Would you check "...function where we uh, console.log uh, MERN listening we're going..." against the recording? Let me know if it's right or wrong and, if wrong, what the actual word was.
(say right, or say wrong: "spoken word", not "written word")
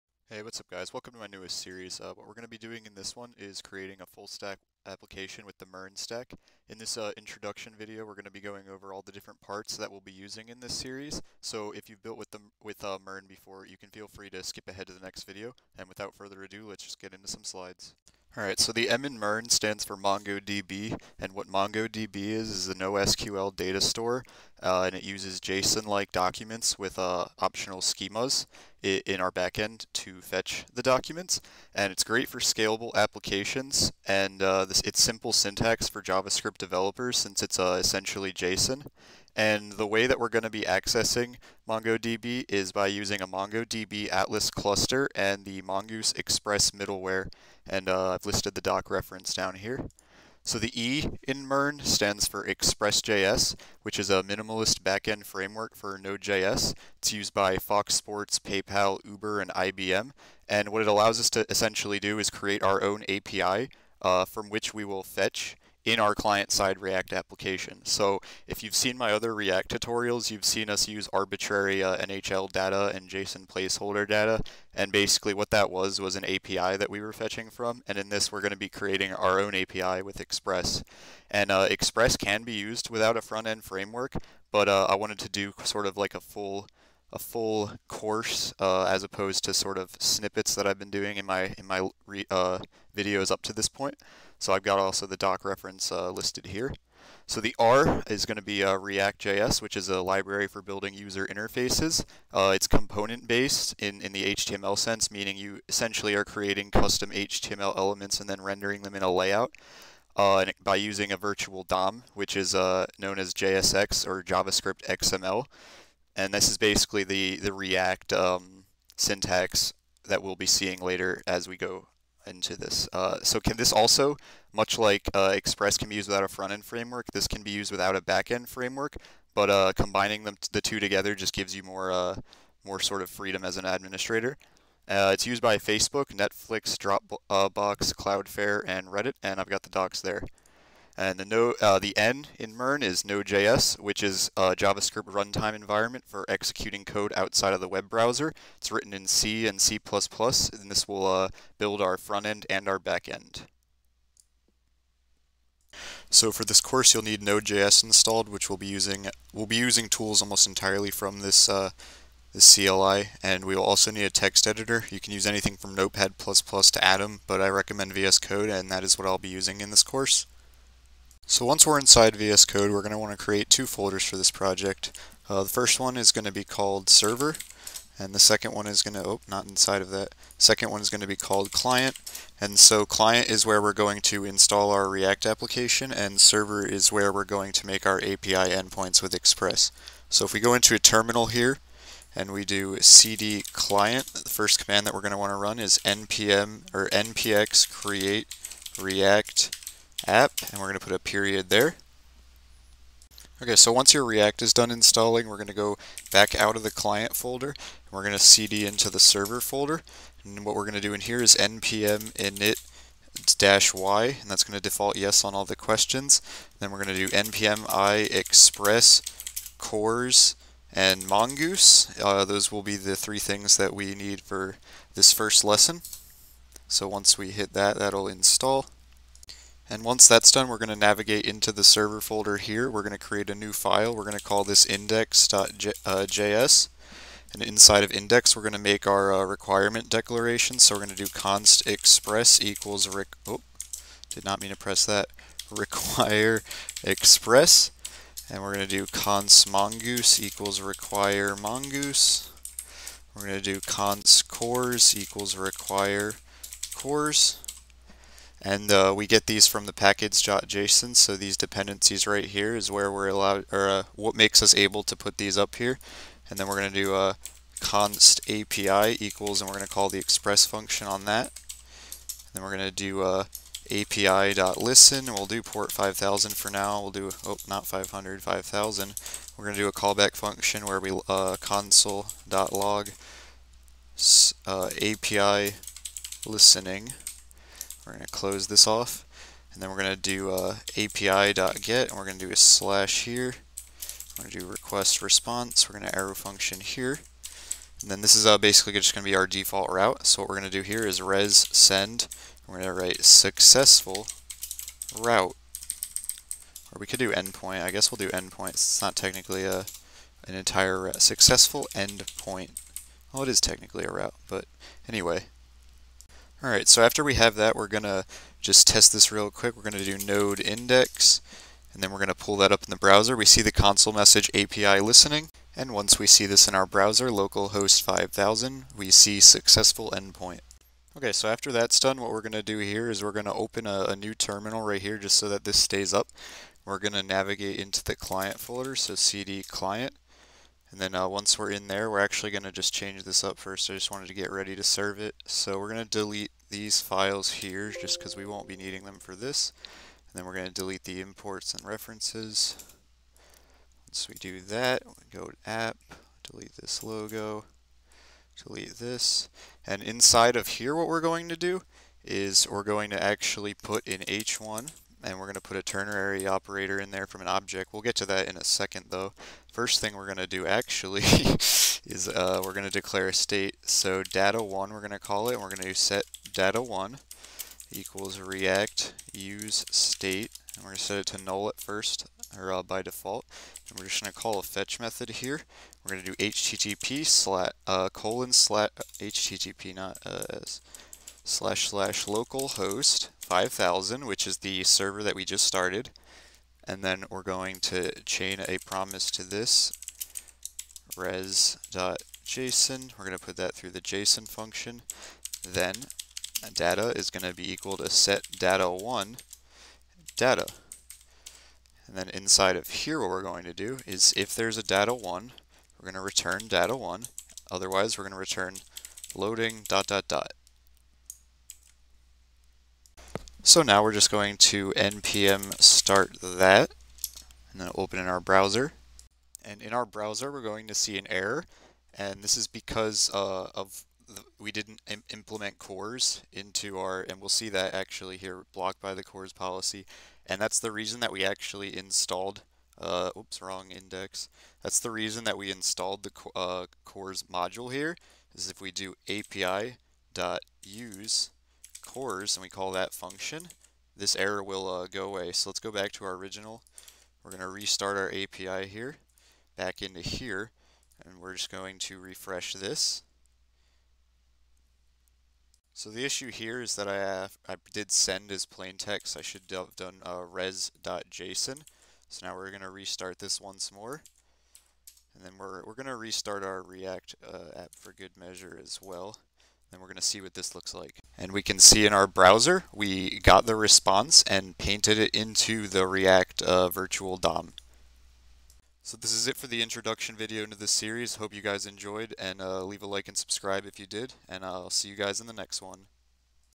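wrong: "API", not "MERN".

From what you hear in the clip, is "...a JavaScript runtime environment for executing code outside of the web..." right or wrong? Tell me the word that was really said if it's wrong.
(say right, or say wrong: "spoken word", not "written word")
right.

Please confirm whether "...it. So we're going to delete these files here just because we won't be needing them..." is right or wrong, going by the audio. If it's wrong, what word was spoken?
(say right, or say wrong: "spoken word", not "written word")
right.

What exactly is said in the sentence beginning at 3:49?
And once that's done, we're going to navigate into the server folder here.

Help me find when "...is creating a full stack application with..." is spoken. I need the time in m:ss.
0:03.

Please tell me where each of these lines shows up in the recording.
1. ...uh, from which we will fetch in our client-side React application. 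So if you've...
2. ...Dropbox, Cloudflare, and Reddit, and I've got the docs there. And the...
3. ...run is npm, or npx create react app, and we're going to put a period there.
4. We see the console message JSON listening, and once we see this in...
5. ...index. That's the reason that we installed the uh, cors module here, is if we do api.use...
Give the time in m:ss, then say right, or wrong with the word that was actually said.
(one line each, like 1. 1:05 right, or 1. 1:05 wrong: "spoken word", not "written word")
1. 1:04 right
2. 2:16 right
3. 3:15 right
4. 5:23 wrong: "API", not "JSON"
5. 7:23 right.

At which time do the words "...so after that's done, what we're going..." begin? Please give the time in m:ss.
5:31.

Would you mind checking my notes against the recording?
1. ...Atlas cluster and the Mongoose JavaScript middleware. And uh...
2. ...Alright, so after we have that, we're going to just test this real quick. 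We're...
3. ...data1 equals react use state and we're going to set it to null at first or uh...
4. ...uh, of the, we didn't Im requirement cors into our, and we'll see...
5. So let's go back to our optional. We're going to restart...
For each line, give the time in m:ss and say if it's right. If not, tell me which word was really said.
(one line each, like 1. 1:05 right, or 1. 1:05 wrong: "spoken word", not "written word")
1. 0:44 wrong: "Express", not "JavaScript"
2. 5:16 right
3. 6:16 right
4. 7:13 wrong: "implement", not "requirement"
5. 7:35 wrong: "original", not "optional".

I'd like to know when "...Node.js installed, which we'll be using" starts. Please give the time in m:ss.
2:37.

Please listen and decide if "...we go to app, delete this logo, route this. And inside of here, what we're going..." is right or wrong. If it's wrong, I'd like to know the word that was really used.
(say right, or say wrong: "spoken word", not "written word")
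wrong: "delete", not "route".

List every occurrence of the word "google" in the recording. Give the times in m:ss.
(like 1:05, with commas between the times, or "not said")
not said.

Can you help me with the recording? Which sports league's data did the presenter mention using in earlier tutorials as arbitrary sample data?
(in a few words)
NHL.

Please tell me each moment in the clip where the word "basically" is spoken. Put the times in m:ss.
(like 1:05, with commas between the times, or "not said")
1:14, 1:56, 4:58.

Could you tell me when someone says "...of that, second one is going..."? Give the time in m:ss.
2:59.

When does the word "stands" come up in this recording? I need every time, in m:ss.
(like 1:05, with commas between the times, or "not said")
0:19, 0:51.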